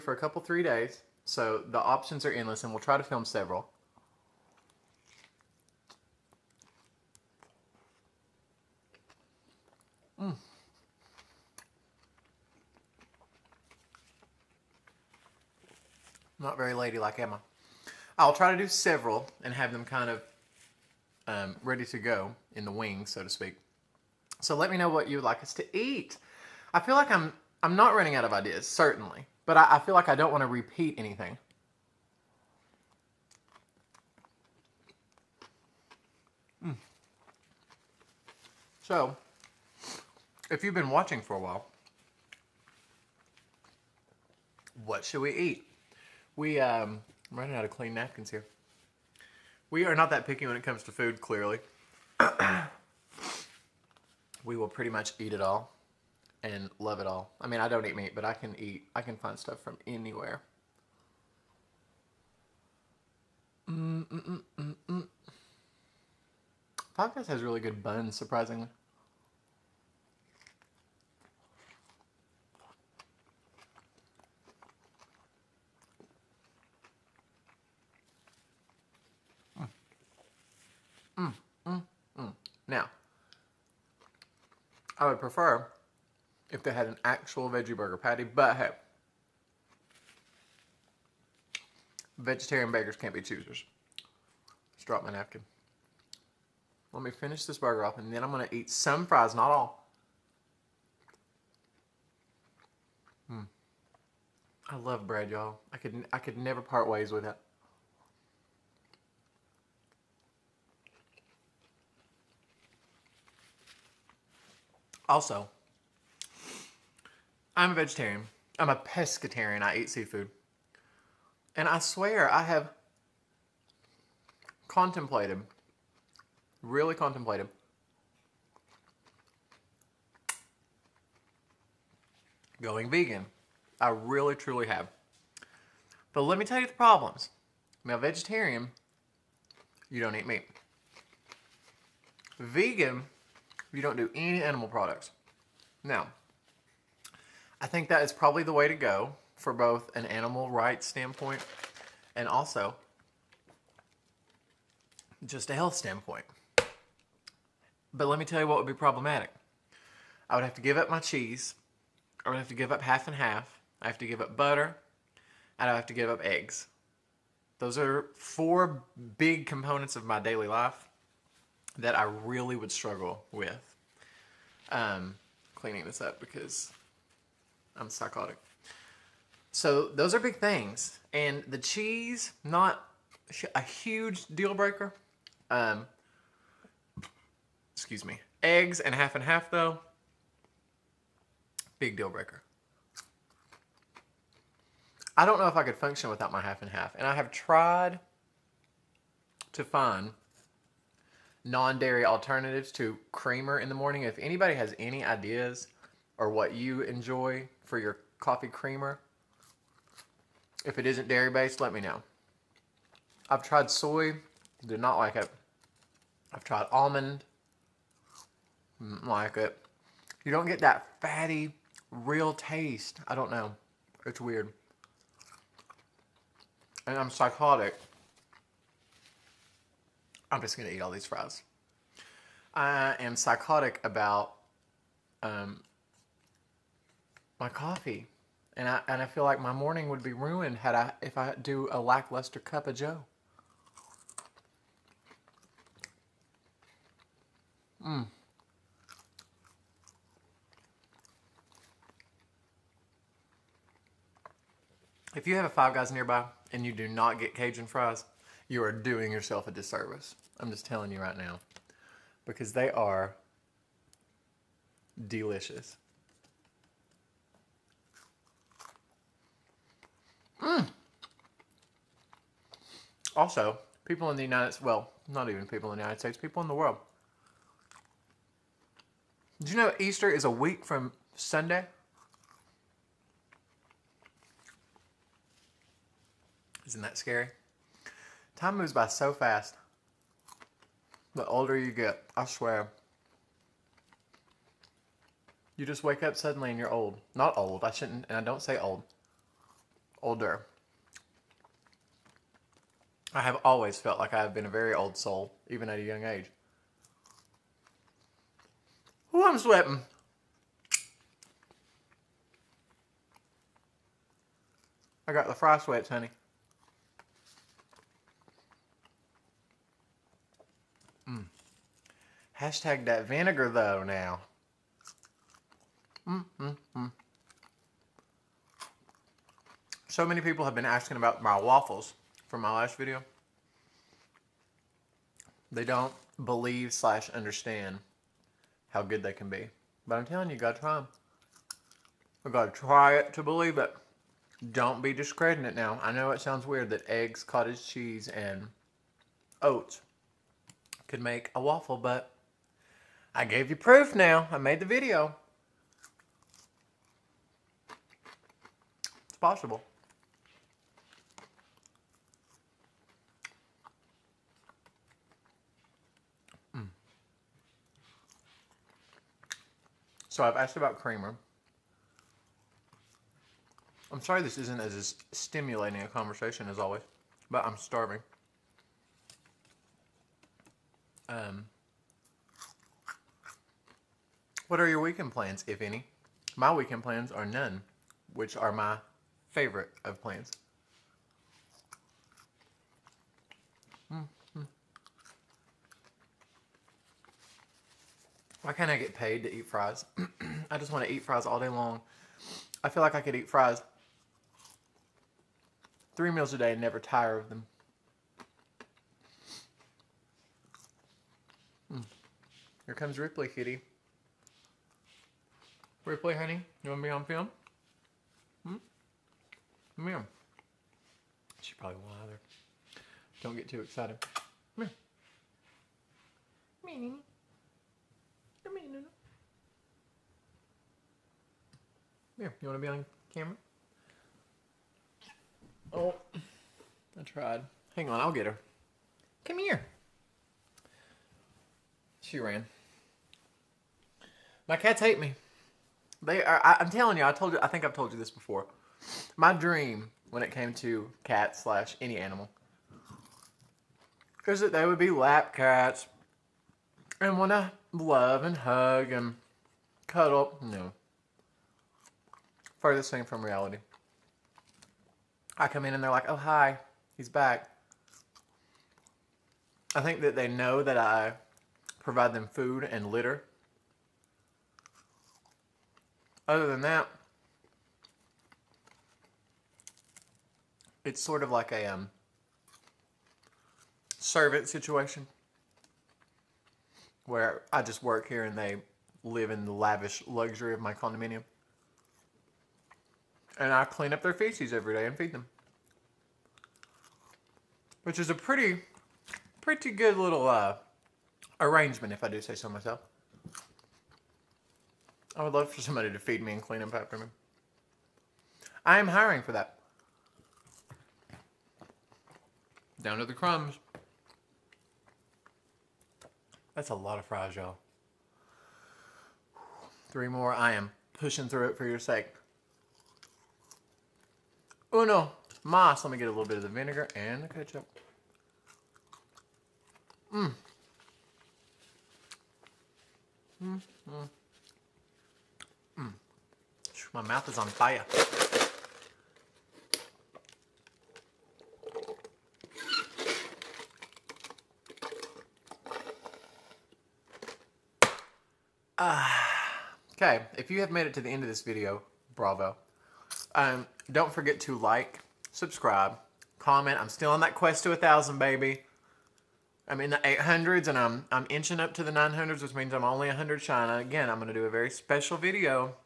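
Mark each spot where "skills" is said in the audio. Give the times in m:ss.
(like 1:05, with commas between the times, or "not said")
not said.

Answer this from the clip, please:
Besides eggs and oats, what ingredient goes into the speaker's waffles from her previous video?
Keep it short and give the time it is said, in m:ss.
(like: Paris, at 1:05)
cottage cheese, at 5:47.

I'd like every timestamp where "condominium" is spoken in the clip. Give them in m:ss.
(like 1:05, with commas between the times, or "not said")
8:10.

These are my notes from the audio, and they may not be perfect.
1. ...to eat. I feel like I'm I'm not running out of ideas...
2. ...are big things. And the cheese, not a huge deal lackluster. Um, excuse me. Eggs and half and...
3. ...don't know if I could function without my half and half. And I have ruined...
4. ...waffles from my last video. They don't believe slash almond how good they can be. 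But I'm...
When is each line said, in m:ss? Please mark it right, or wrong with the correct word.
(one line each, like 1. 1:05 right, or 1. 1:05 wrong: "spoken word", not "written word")
1. 0:25 right
2. 3:00 wrong: "breaker", not "lackluster"
3. 3:15 wrong: "tried", not "ruined"
4. 5:31 wrong: "understand", not "almond".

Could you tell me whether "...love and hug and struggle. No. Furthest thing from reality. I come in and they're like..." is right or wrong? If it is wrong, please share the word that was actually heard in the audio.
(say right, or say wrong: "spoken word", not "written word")
wrong: "cuddle", not "struggle".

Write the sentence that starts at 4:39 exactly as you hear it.
Did you know Easter is a week from Sunday?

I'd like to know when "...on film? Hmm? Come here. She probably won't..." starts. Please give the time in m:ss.
6:56.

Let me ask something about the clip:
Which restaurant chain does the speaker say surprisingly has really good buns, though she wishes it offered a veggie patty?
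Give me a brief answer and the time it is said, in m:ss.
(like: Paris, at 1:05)
Podcast, at 1:06.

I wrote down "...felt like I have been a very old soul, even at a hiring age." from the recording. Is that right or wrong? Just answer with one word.
wrong.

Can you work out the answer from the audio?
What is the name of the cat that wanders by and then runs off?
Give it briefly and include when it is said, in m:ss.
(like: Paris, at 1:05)
Ripley, at 6:52.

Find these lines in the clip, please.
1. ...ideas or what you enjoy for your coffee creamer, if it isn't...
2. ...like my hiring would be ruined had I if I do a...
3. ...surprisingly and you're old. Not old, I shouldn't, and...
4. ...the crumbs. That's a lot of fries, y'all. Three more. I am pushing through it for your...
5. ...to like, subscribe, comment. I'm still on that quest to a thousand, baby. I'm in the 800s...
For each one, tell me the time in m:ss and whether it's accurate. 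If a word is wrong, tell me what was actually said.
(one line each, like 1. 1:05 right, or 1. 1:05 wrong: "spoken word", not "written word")
1. 3:25 right
2. 3:59 wrong: "morning", not "hiring"
3. 4:56 wrong: "suddenly", not "surprisingly"
4. 8:33 right
5. 9:14 right.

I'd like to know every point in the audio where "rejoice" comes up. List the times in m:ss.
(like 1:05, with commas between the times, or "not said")
not said.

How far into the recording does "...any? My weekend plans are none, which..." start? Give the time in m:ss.
6:25.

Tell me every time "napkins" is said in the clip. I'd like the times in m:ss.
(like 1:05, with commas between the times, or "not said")
0:47, 1:35.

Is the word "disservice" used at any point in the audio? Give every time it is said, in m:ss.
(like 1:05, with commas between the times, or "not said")
4:19.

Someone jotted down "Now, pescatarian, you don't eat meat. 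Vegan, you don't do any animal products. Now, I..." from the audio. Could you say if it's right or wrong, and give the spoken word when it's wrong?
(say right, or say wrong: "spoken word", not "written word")
wrong: "vegetarian", not "pescatarian".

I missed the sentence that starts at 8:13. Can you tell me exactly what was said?
And I clean up their feces every day and feed them.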